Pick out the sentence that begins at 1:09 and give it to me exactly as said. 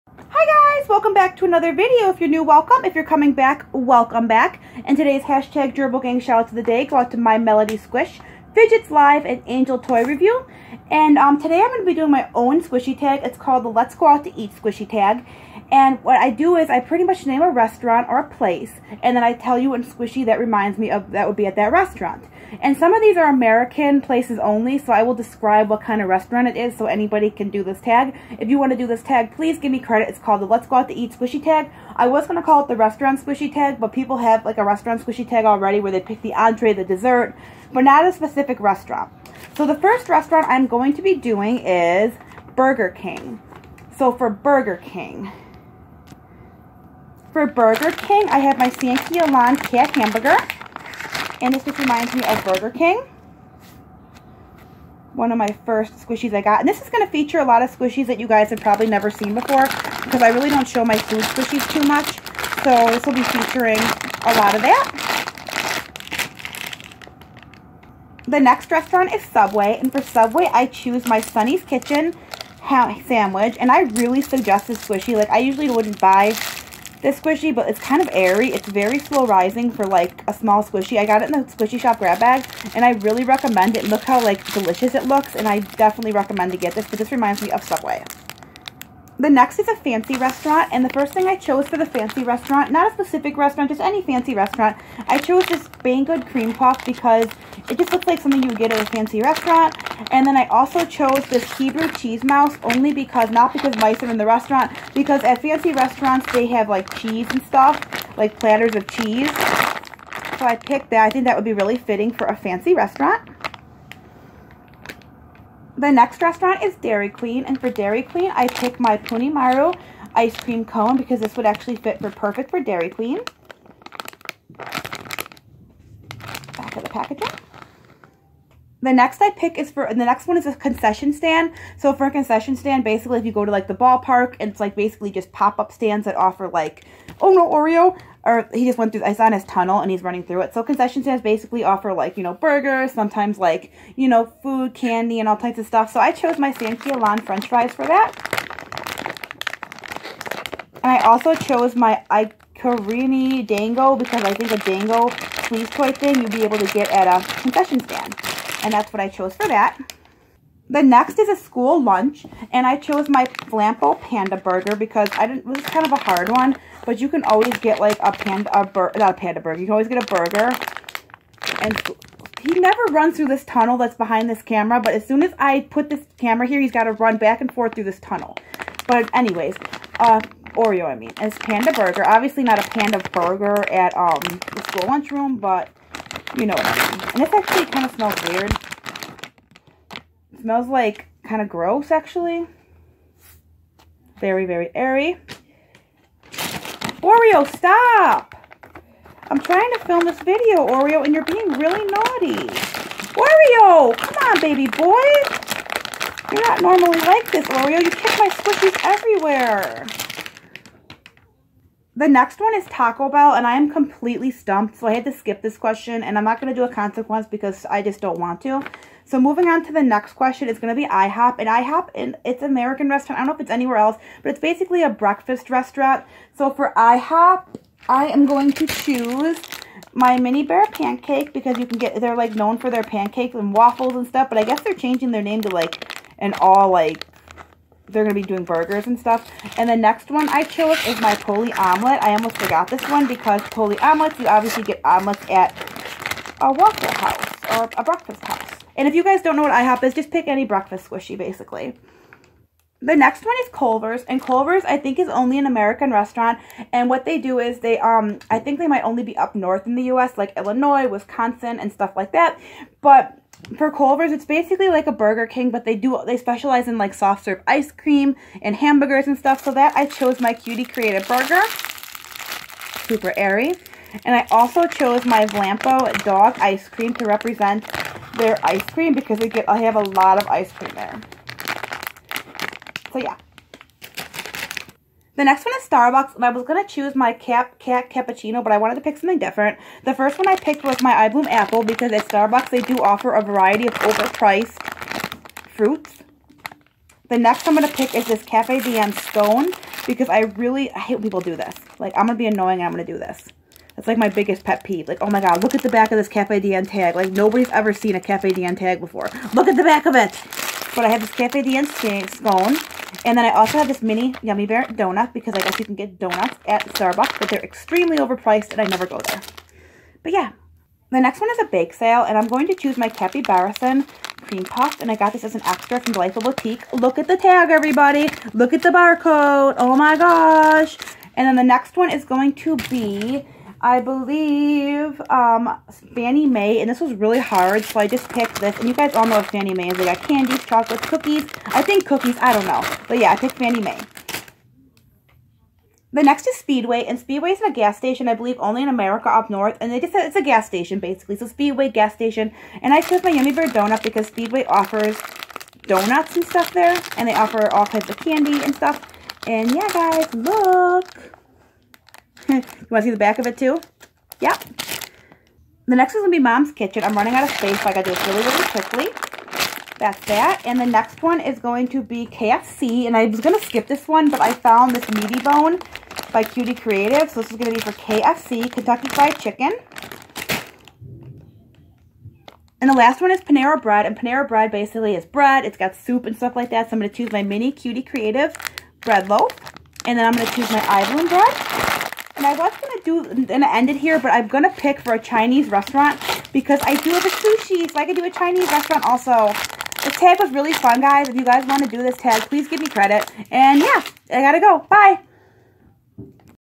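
And for Subway, I choose my Sunny's Kitchen sandwich.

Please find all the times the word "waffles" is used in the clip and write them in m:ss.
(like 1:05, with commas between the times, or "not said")
3:53, 4:06.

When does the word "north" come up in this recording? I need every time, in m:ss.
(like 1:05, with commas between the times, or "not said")
4:19, 5:49.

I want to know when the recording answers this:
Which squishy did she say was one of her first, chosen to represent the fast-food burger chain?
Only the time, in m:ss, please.
0:48.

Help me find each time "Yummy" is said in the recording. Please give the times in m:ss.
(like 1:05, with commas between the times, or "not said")
5:14, 5:53.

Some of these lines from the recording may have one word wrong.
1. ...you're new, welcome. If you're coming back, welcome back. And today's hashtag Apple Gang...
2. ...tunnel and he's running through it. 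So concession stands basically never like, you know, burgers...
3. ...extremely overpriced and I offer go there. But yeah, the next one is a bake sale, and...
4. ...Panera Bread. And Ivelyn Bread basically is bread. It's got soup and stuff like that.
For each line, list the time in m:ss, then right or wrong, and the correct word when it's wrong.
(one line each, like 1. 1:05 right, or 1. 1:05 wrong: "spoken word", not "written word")
1. 0:02 wrong: "Gerbil", not "Apple"
2. 2:19 wrong: "offer", not "never"
3. 5:17 wrong: "never", not "offer"
4. 6:23 wrong: "Panera", not "Ivelyn".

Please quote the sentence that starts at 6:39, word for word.
This tag was really fun, guys.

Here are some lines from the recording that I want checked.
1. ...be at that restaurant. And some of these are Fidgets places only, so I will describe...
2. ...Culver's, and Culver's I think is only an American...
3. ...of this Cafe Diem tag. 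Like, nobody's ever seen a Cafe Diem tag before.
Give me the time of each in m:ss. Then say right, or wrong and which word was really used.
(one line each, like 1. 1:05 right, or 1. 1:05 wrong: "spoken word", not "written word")
1. 0:21 wrong: "American", not "Fidgets"
2. 4:13 right
3. 5:05 right.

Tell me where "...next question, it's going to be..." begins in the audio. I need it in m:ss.
3:39.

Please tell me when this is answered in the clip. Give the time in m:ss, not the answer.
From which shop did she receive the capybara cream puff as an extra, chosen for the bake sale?
5:25.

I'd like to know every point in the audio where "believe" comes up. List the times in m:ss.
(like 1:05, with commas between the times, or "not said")
5:33, 5:48.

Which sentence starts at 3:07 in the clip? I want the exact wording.
And this actually kind of smells weird.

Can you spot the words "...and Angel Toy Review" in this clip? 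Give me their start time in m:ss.
0:09.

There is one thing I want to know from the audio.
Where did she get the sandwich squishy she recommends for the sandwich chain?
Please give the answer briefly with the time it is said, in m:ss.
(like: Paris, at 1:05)
Squishy Shop grab bag, at 1:21.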